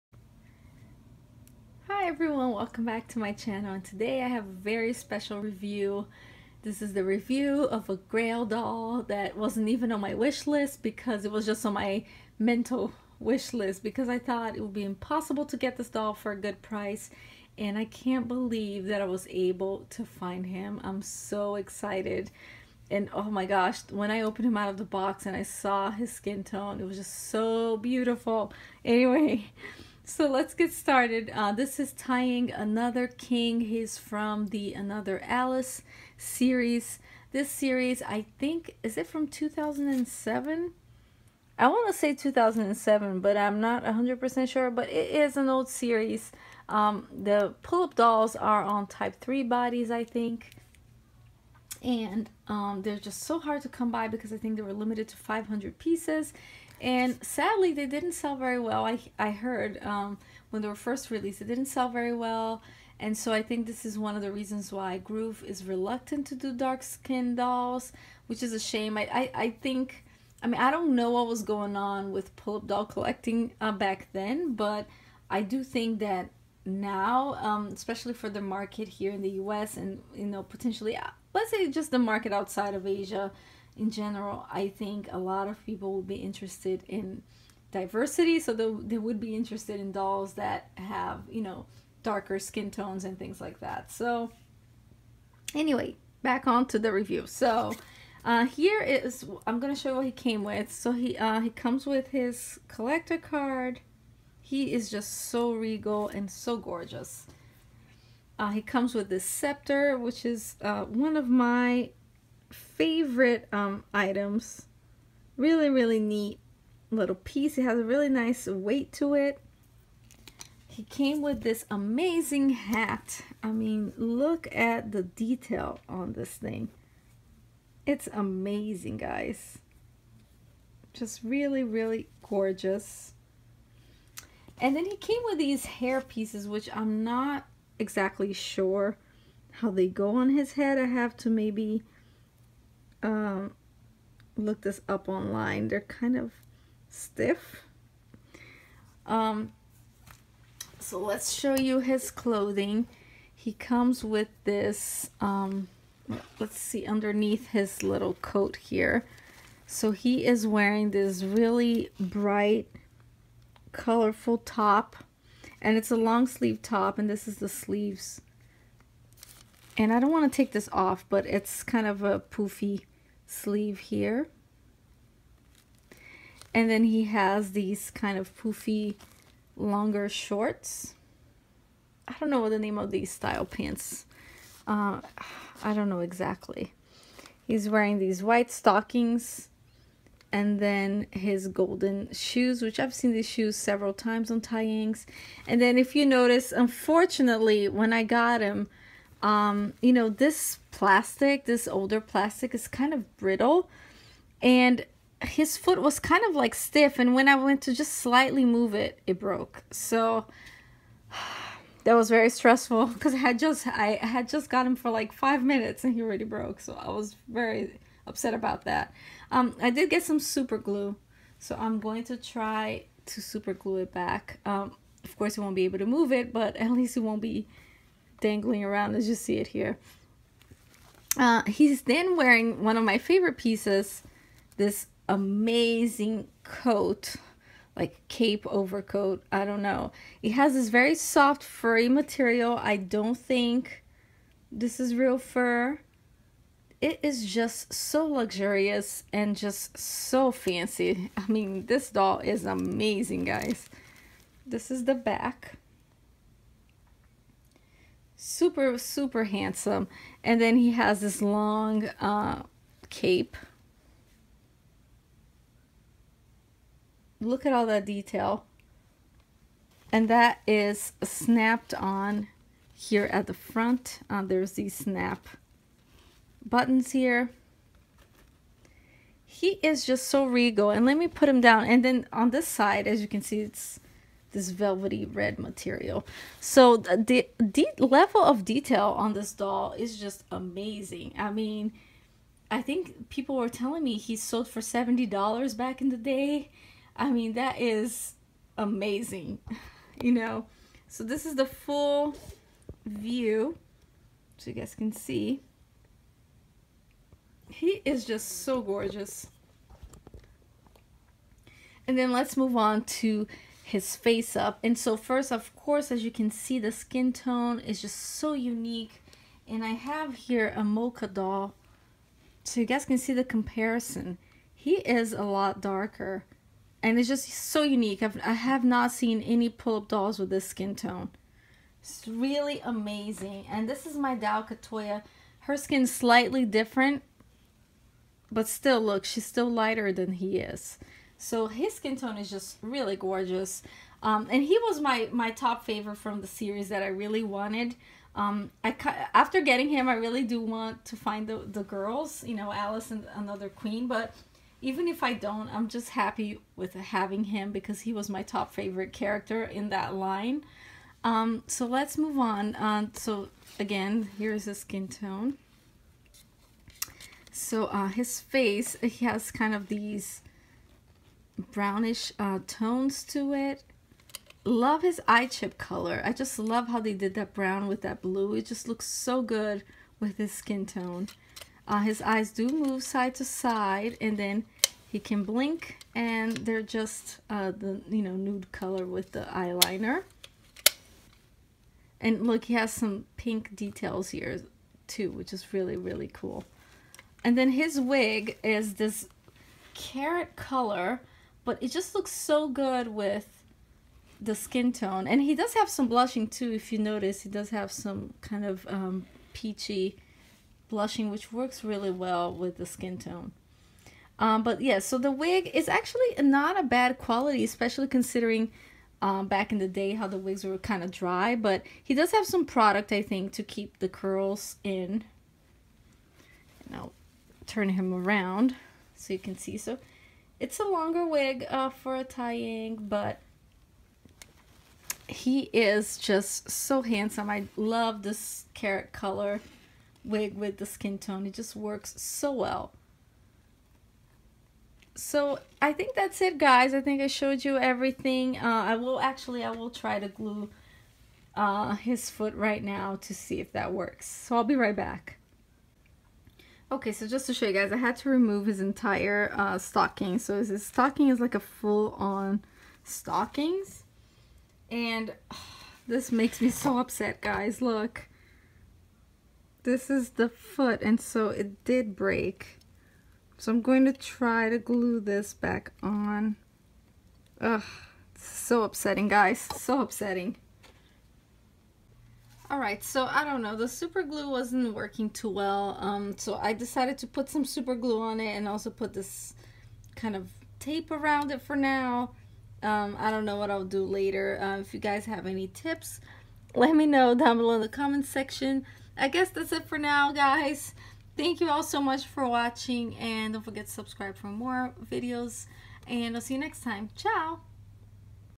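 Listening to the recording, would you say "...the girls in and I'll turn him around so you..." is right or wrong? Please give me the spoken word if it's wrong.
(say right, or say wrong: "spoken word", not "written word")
wrong: "curls", not "girls".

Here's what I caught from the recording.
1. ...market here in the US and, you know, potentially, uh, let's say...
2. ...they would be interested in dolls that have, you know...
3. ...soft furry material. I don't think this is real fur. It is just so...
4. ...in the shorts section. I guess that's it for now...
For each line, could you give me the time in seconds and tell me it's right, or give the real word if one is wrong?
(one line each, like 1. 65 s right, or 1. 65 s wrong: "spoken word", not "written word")
1. 78 s right
2. 88 s right
3. 240 s right
4. 497 s wrong: "comments", not "shorts".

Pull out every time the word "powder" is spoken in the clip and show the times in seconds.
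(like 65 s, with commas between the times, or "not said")
not said.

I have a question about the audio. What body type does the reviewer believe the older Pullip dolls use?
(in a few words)
type 3.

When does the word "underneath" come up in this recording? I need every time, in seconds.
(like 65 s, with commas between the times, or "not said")
156 s.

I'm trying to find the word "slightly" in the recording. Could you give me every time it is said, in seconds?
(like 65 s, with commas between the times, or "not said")
207 s, 335 s.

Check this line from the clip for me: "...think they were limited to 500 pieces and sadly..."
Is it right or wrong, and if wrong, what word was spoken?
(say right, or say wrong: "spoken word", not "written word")
right.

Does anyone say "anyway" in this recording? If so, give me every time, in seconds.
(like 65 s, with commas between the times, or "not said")
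28 s, 95 s.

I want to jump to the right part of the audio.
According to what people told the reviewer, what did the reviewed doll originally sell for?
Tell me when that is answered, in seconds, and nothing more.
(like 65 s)
294 s.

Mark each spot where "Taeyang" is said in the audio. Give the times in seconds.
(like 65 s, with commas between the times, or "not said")
31 s, 194 s, 432 s.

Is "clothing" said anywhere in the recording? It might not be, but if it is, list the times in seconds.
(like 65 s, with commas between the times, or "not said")
152 s.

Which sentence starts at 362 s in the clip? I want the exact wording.
Uh, so again, here's his skin tone.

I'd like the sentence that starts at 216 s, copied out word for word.
So I was very upset about that.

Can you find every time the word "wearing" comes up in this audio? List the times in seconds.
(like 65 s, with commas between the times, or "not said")
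160 s, 187 s, 232 s.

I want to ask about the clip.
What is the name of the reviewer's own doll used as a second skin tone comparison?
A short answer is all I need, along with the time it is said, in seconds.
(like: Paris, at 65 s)
Katoya, at 334 s.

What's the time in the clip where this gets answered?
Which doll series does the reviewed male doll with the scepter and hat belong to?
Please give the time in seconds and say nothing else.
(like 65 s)
34 s.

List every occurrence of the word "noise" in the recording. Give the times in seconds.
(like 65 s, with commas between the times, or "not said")
not said.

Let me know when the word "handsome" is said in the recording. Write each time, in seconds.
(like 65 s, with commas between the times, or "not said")
259 s, 436 s.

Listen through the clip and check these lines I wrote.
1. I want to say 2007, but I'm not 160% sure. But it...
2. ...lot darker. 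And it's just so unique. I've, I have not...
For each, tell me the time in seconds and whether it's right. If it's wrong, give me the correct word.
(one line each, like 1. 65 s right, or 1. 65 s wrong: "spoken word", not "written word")
1. 41 s wrong: "100", not "160"
2. 325 s right.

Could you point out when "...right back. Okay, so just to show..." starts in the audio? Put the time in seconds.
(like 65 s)
454 s.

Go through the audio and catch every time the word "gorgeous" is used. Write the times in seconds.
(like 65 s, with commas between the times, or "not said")
106 s, 132 s, 308 s, 342 s.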